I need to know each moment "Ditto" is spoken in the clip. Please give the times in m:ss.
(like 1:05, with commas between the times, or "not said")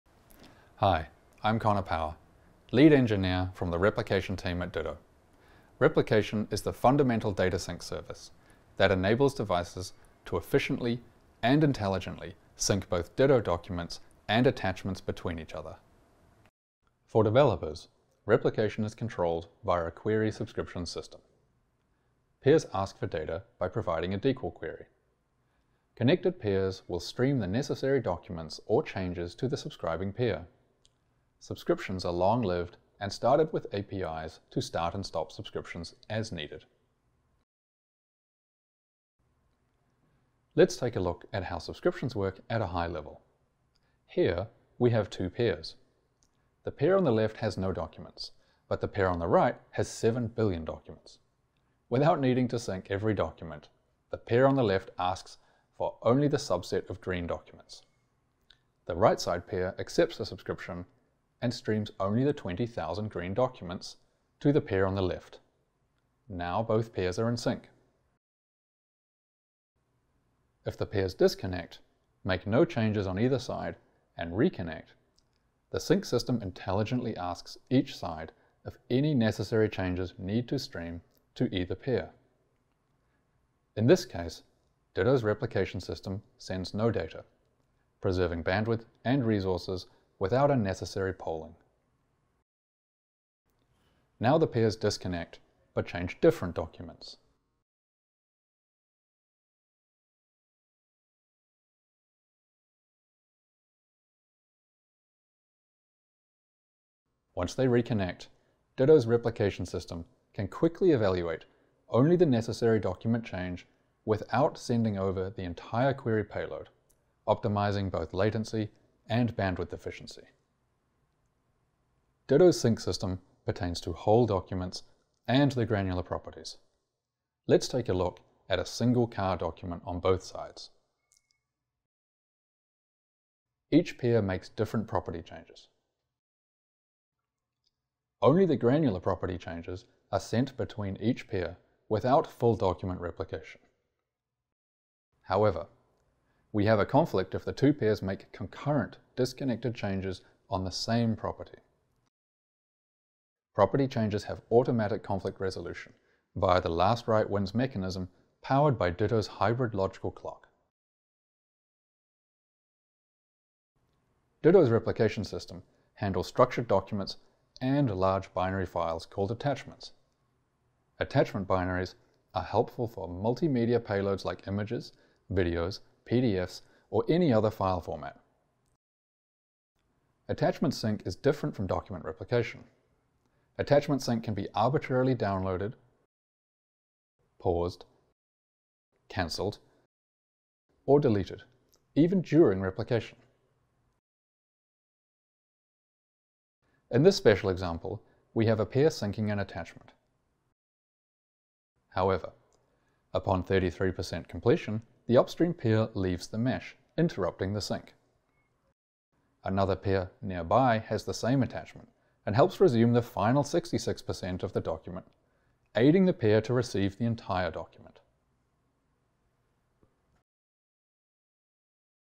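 0:04, 0:13, 1:24, 1:48, 2:02, 2:38, 2:44.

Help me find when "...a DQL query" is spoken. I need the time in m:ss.
0:24.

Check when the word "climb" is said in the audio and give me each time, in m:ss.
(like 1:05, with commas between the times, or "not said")
not said.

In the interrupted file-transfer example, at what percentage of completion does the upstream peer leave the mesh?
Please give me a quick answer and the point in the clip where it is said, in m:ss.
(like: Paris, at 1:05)
33%, at 3:23.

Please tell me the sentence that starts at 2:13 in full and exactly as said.
Each pair makes different property changes.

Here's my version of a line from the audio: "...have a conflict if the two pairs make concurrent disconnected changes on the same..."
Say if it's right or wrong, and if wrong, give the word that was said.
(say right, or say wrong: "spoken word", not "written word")
right.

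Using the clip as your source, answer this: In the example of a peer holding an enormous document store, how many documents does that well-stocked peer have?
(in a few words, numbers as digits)
7 billion.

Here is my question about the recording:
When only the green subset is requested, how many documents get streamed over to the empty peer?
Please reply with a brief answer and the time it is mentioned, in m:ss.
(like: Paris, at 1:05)
20,000, at 1:02.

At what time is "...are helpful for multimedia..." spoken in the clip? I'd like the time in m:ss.
2:52.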